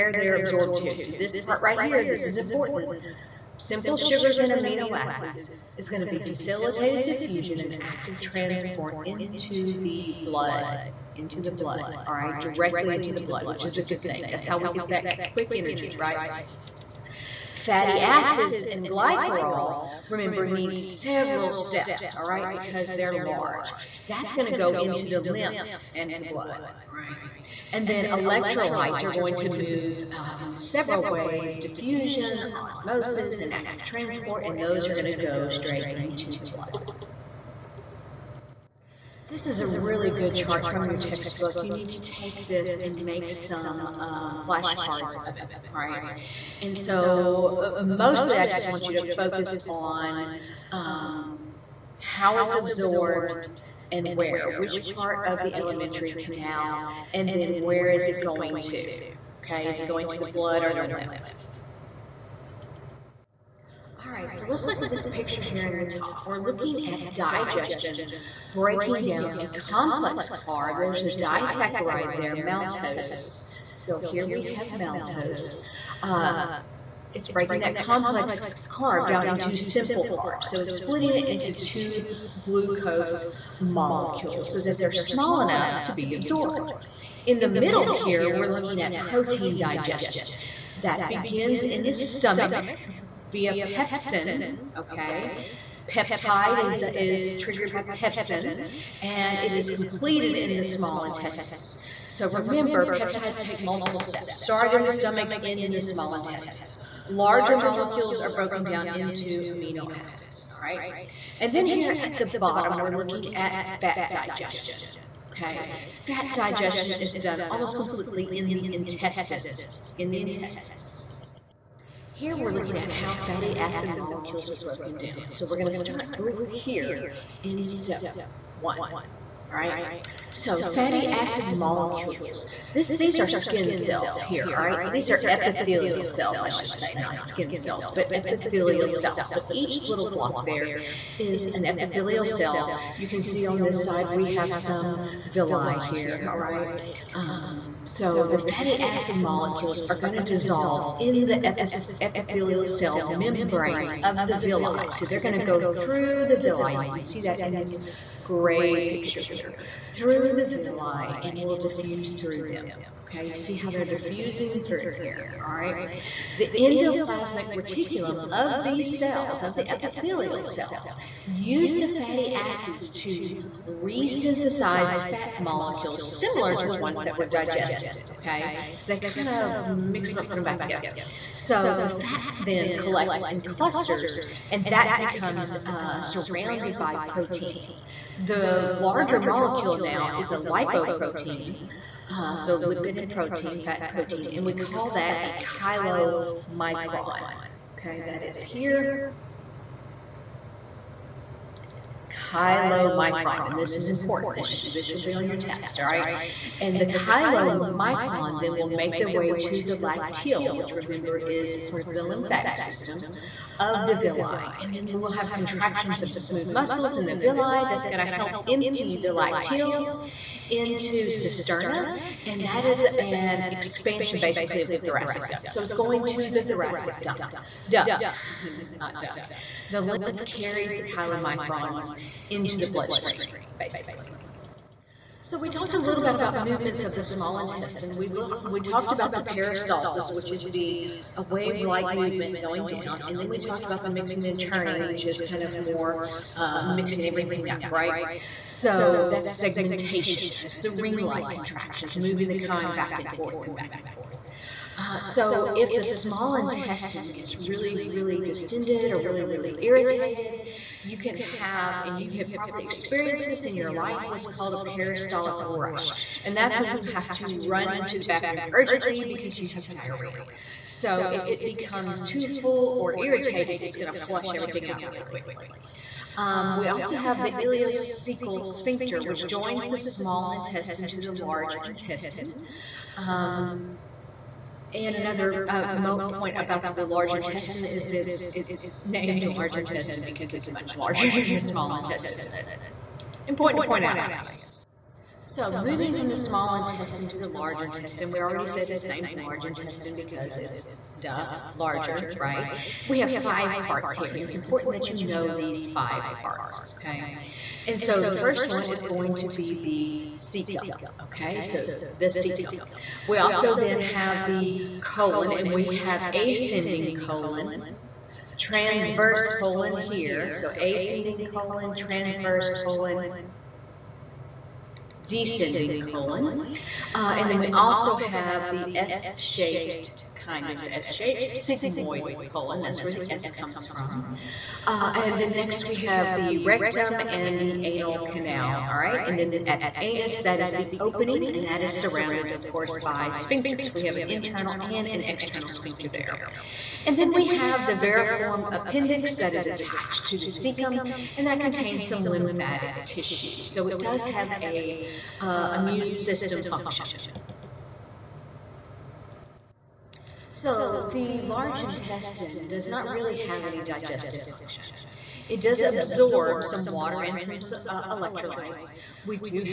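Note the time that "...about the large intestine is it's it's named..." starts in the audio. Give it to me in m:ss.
4:46.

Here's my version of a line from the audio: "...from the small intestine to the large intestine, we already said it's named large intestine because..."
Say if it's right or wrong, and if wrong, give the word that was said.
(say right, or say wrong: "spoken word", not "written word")
right.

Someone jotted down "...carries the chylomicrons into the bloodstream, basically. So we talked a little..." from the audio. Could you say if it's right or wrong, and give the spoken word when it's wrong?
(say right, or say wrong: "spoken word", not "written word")
right.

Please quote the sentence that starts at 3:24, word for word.
This, this will be on your test, all right?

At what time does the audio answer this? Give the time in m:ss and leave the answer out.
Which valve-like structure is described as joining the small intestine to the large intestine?
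4:37.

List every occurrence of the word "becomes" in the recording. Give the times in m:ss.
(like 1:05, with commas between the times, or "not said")
3:04, 4:31.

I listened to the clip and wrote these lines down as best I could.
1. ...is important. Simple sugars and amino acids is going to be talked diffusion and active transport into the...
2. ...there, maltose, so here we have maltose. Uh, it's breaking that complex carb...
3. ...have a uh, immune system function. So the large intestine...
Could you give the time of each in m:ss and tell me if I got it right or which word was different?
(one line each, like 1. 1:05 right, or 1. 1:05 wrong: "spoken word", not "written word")
1. 0:02 wrong: "facilitated", not "talked"
2. 1:12 right
3. 5:54 right.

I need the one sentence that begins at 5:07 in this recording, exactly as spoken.
And so the first one is going to be the cecum, okay?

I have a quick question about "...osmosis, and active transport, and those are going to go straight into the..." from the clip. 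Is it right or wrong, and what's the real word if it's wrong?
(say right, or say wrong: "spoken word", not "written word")
right.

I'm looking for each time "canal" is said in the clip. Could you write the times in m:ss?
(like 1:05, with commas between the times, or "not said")
0:56, 5:38.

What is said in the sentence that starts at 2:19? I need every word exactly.
So each little block there is an epithelial cell.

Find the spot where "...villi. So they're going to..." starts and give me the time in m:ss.
2:34.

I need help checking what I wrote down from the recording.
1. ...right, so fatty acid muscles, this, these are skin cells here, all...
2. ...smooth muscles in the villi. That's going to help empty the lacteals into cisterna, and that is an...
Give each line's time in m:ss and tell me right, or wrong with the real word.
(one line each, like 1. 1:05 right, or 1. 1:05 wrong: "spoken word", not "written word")
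1. 2:09 wrong: "molecules", not "muscles"
2. 3:36 right.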